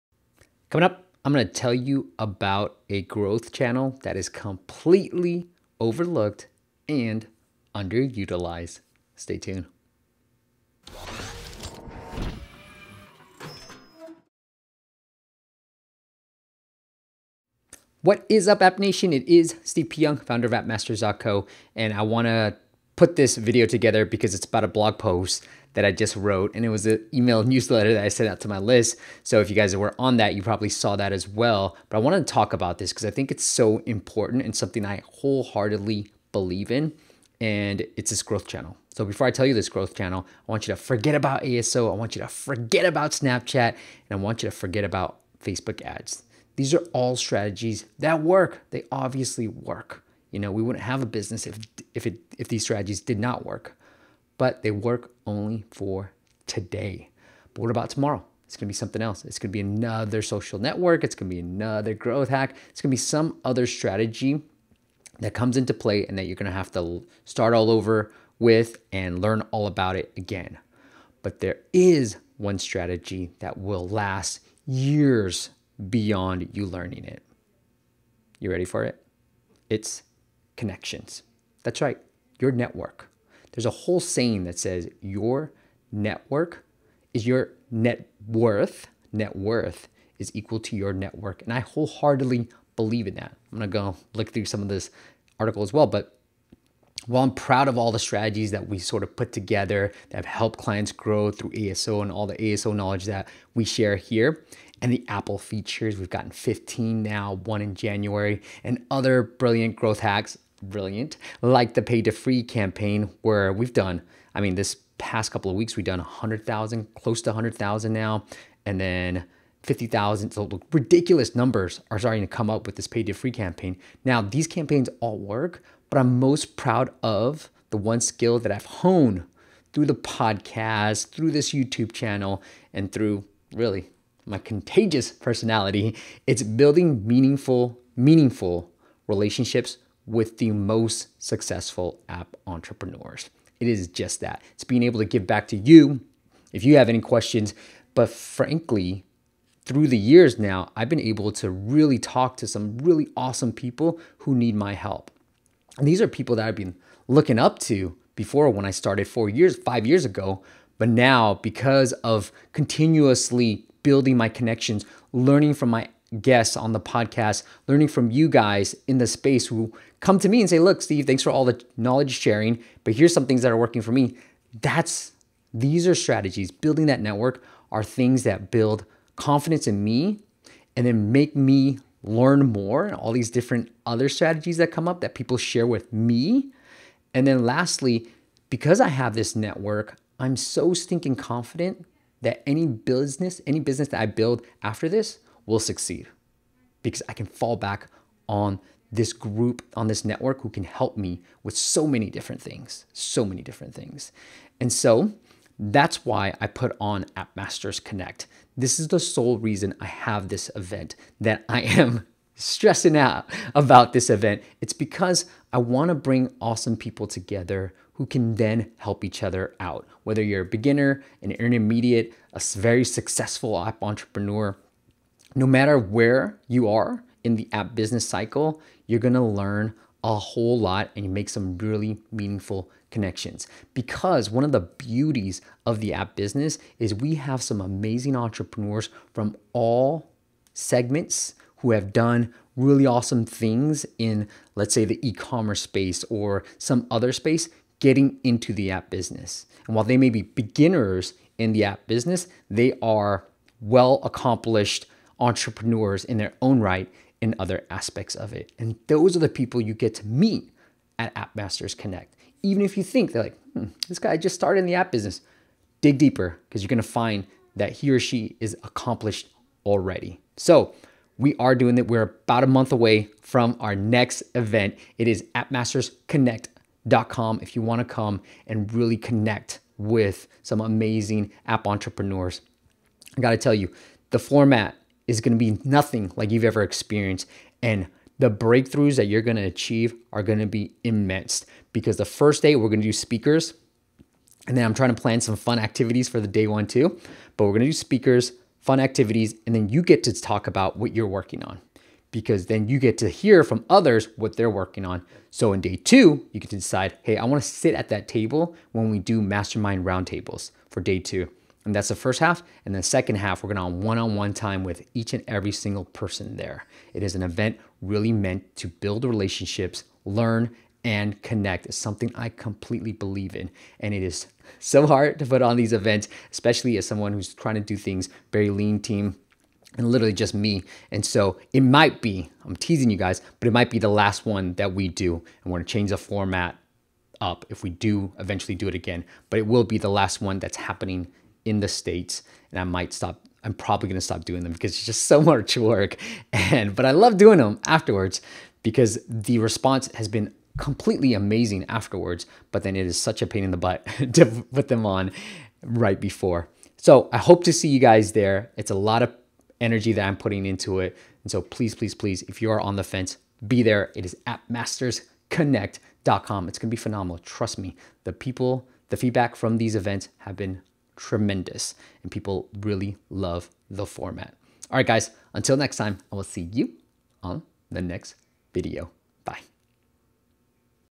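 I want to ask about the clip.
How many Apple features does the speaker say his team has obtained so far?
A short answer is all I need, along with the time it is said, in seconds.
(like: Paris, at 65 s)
15, at 106 s.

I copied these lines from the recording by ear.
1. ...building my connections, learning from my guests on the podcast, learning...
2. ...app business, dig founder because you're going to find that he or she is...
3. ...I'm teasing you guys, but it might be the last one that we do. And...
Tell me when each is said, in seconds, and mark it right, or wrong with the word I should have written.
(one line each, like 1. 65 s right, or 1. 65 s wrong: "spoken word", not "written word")
1. 163 s right
2. 264 s wrong: "deeper", not "founder"
3. 332 s right.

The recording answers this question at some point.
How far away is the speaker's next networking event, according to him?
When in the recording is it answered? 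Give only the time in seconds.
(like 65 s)
272 s.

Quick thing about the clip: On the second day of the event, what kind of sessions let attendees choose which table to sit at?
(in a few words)
Mastermind roundtables.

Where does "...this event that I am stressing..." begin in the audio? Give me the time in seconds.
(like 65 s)
210 s.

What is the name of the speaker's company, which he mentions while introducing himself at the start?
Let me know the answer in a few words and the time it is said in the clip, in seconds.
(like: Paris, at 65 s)
AppMasters.co, at 20 s.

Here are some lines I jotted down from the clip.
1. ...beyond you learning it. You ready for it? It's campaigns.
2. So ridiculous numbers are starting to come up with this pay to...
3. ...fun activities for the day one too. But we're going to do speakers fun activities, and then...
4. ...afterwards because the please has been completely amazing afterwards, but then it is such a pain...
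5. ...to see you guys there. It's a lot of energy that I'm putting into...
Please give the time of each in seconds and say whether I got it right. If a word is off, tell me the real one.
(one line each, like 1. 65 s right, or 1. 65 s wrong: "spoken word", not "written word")
1. 75 s wrong: "connections", not "campaigns"
2. 120 s right
3. 295 s right
4. 347 s wrong: "response", not "please"
5. 357 s right.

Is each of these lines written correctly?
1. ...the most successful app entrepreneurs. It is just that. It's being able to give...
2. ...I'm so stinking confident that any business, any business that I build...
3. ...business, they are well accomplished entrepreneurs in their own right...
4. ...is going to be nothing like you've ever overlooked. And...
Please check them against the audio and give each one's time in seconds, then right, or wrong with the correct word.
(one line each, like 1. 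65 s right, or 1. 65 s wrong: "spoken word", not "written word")
1. 140 s right
2. 190 s right
3. 251 s right
4. 285 s wrong: "experienced", not "overlooked".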